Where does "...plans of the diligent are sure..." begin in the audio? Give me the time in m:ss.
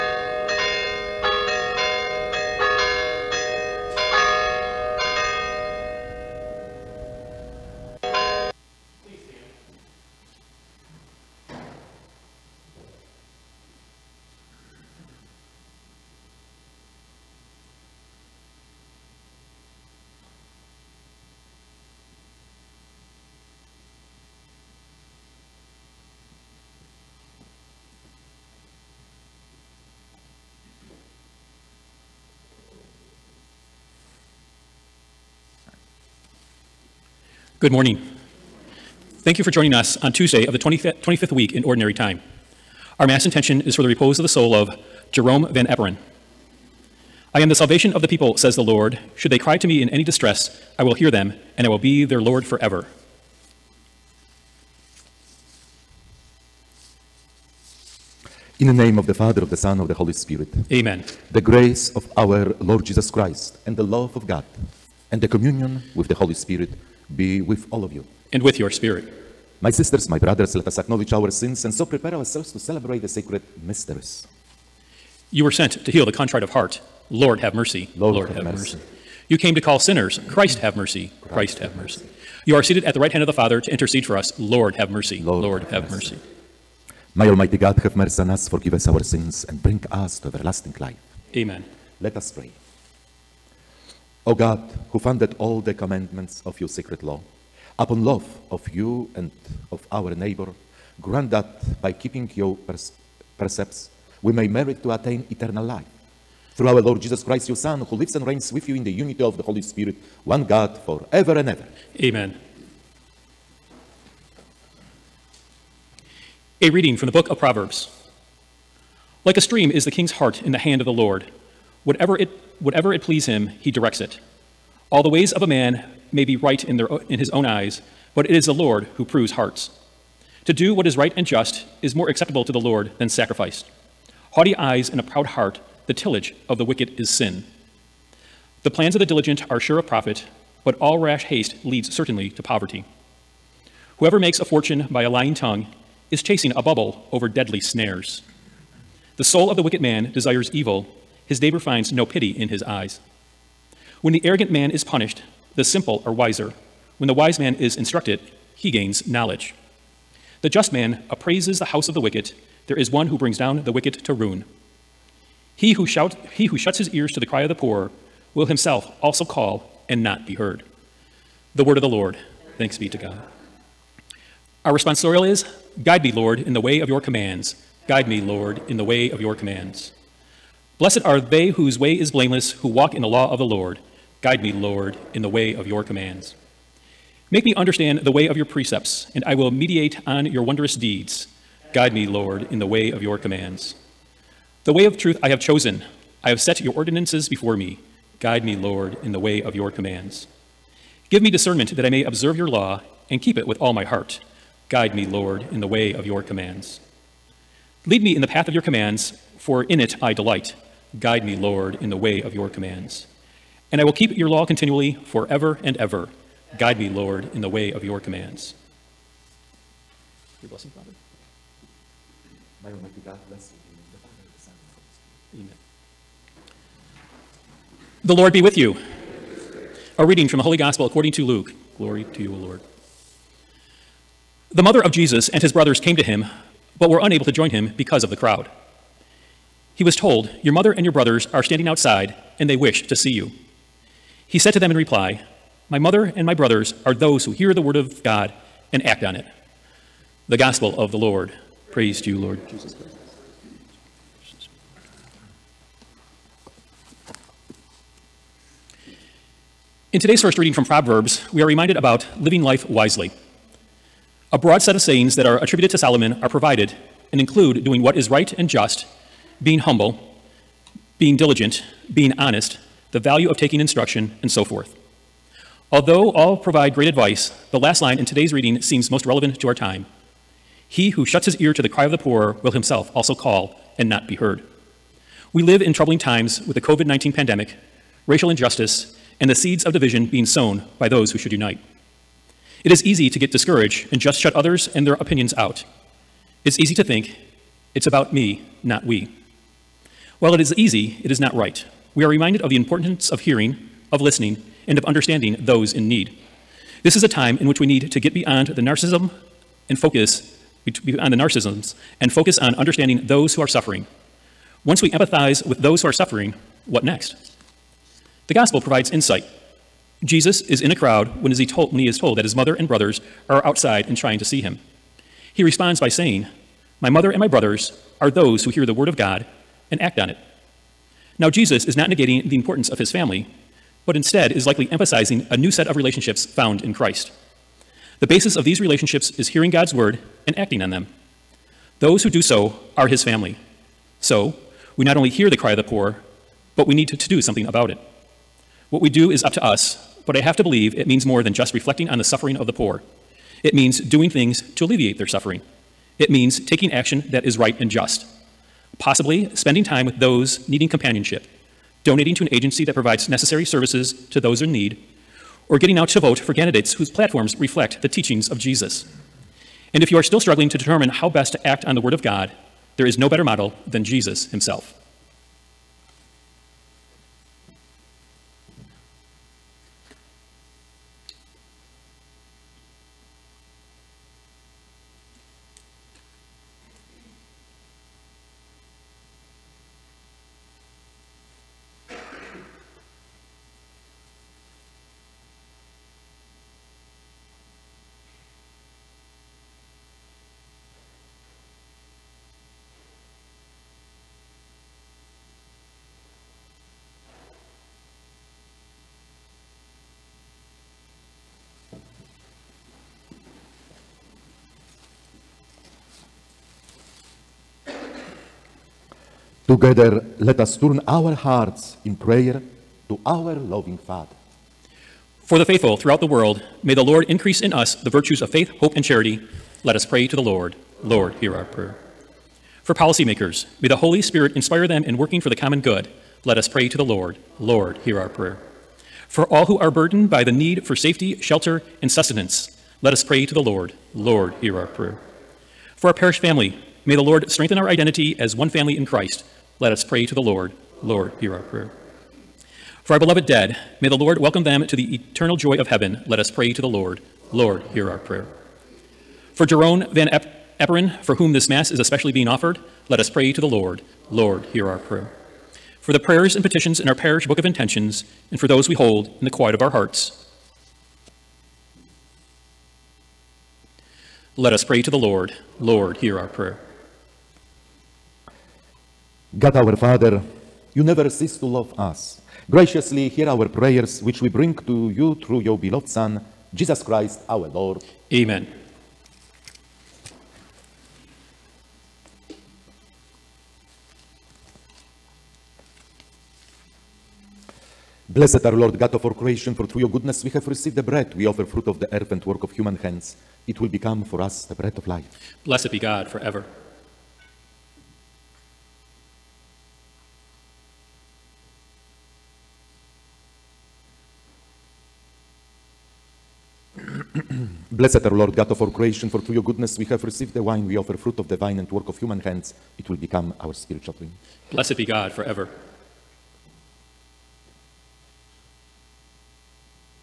2:18.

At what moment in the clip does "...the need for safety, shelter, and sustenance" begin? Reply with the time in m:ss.
7:20.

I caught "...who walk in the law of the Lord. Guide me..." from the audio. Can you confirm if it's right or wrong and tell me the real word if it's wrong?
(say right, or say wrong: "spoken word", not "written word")
right.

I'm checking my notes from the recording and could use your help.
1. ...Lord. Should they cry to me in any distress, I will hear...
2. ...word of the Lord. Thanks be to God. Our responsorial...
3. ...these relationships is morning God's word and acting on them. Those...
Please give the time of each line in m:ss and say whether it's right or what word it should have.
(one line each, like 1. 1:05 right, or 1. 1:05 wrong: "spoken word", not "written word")
1. 0:48 right
2. 2:51 right
3. 5:38 wrong: "hearing", not "morning".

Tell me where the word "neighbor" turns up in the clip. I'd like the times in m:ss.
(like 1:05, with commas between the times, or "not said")
1:40, 2:31.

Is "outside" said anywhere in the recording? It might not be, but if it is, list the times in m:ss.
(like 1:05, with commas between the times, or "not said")
4:01, 5:23.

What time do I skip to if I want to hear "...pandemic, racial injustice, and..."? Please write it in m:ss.
4:47.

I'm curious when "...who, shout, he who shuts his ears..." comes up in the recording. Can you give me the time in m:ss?
2:45.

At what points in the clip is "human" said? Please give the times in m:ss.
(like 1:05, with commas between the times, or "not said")
8:22, 8:41.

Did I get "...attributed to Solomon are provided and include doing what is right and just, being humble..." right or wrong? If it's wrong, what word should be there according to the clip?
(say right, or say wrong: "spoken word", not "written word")
right.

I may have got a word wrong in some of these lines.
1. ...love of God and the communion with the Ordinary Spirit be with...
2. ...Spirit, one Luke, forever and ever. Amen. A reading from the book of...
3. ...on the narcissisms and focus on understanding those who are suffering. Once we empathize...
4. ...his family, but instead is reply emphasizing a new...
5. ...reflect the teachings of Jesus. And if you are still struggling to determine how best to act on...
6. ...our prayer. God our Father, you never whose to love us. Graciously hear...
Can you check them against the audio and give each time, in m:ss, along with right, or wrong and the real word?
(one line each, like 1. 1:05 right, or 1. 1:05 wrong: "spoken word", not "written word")
1. 1:03 wrong: "Holy", not "Ordinary"
2. 1:49 wrong: "God", not "Luke"
3. 5:10 right
4. 5:32 wrong: "likely", not "reply"
5. 6:07 right
6. 7:56 wrong: "cease", not "whose".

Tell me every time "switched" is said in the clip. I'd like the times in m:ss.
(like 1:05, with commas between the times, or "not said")
not said.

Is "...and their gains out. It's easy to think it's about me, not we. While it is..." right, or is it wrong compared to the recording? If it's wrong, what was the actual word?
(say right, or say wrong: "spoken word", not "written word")
wrong: "opinions", not "gains".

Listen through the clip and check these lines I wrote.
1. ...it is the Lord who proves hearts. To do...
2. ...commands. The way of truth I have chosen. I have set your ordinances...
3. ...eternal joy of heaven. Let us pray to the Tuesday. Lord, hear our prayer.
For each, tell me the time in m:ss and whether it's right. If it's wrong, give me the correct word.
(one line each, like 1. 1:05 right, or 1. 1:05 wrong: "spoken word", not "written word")
1. 2:08 right
2. 3:13 right
3. 7:34 wrong: "Lord", not "Tuesday".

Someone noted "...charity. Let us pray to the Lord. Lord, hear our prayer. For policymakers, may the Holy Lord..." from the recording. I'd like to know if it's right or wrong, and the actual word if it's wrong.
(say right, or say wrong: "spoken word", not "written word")
wrong: "Spirit", not "Lord".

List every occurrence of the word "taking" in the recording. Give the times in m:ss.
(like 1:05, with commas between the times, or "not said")
4:33, 5:56.